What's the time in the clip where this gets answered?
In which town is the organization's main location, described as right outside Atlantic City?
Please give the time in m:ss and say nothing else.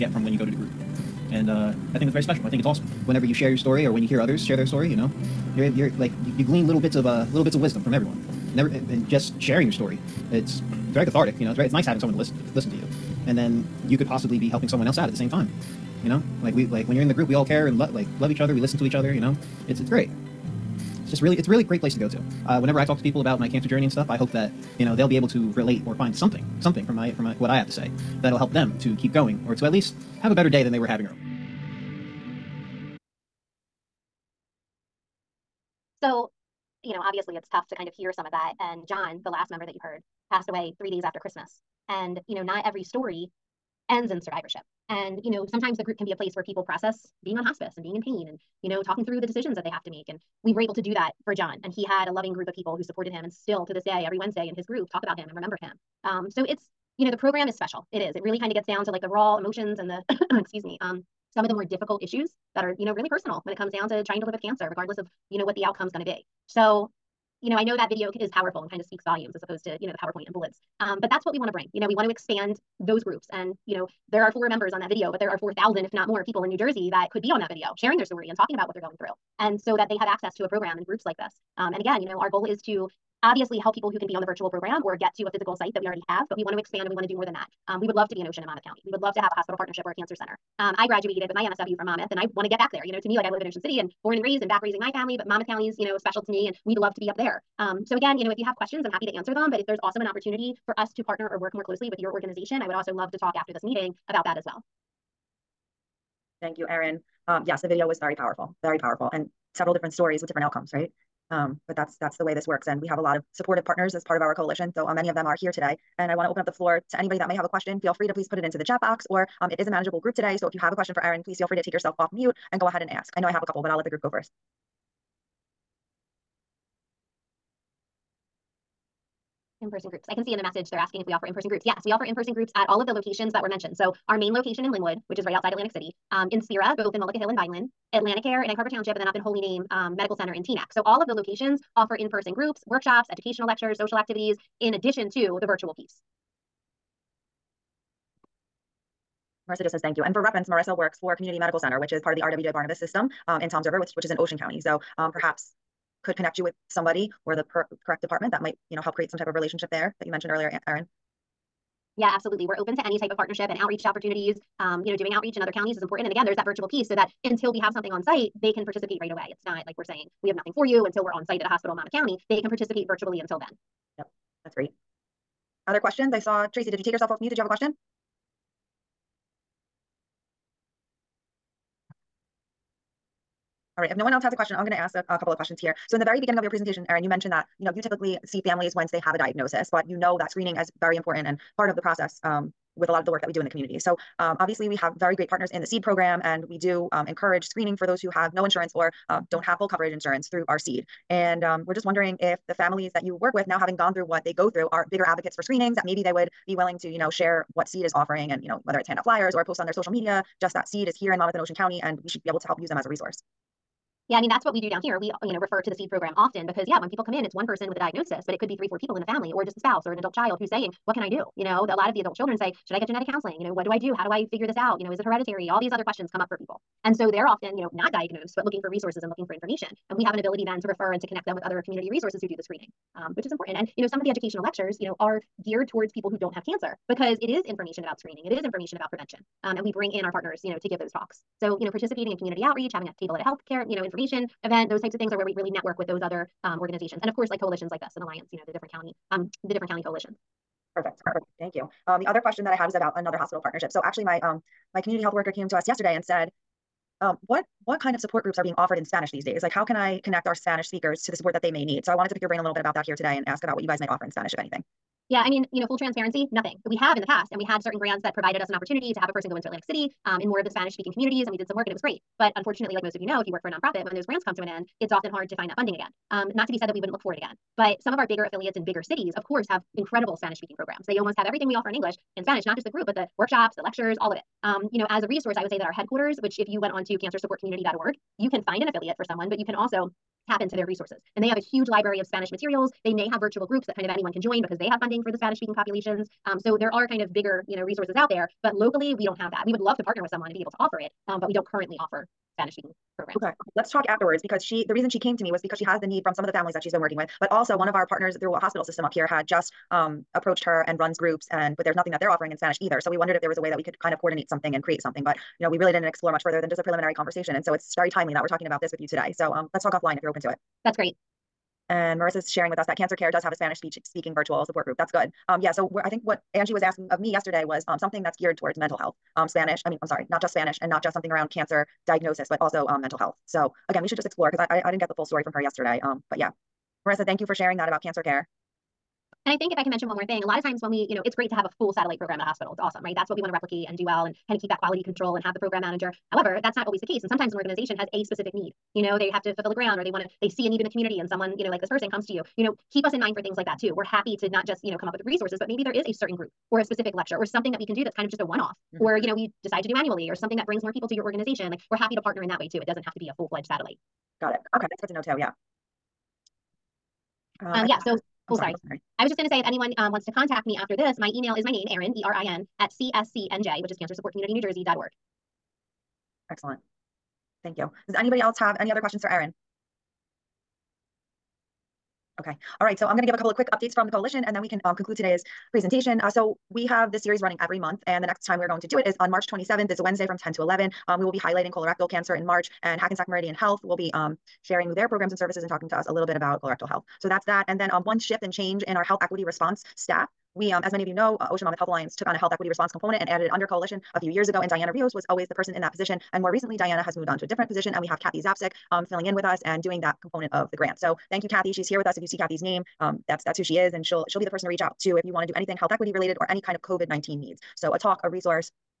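2:14.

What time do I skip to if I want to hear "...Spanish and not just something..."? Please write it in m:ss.
5:30.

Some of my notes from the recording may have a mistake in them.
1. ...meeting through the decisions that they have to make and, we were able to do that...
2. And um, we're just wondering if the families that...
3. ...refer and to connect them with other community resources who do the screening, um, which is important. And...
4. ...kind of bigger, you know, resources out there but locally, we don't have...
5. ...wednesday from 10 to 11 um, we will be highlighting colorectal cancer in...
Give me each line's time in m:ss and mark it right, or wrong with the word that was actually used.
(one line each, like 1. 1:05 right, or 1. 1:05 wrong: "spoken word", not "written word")
1. 0:48 wrong: "talking", not "meeting"
2. 3:21 right
3. 3:50 right
4. 4:56 right
5. 6:29 right.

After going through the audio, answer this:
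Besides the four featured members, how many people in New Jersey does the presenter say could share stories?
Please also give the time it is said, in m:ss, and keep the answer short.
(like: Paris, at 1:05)
4,000, at 1:15.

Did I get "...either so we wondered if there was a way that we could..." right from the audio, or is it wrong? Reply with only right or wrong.
right.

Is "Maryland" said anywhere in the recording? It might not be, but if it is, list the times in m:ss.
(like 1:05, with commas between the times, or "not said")
not said.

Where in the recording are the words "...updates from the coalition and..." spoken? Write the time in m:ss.
6:23.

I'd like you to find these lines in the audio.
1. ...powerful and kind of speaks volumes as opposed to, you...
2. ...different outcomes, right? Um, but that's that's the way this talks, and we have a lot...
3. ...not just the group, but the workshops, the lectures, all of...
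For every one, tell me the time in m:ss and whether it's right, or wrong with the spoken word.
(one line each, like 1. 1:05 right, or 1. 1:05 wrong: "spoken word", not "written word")
1. 1:08 right
2. 1:50 wrong: "works", not "talks"
3. 4:42 right.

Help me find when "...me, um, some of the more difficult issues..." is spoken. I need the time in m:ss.
1:00.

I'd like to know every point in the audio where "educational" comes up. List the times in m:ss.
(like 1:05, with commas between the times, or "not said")
2:23, 3:54.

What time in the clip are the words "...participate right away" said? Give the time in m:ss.
2:48.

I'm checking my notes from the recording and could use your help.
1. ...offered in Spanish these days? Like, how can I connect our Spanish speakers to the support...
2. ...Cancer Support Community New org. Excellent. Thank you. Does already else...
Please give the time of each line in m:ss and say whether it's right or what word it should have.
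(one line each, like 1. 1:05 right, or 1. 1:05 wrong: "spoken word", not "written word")
1. 4:18 right
2. 6:13 wrong: "anybody", not "already".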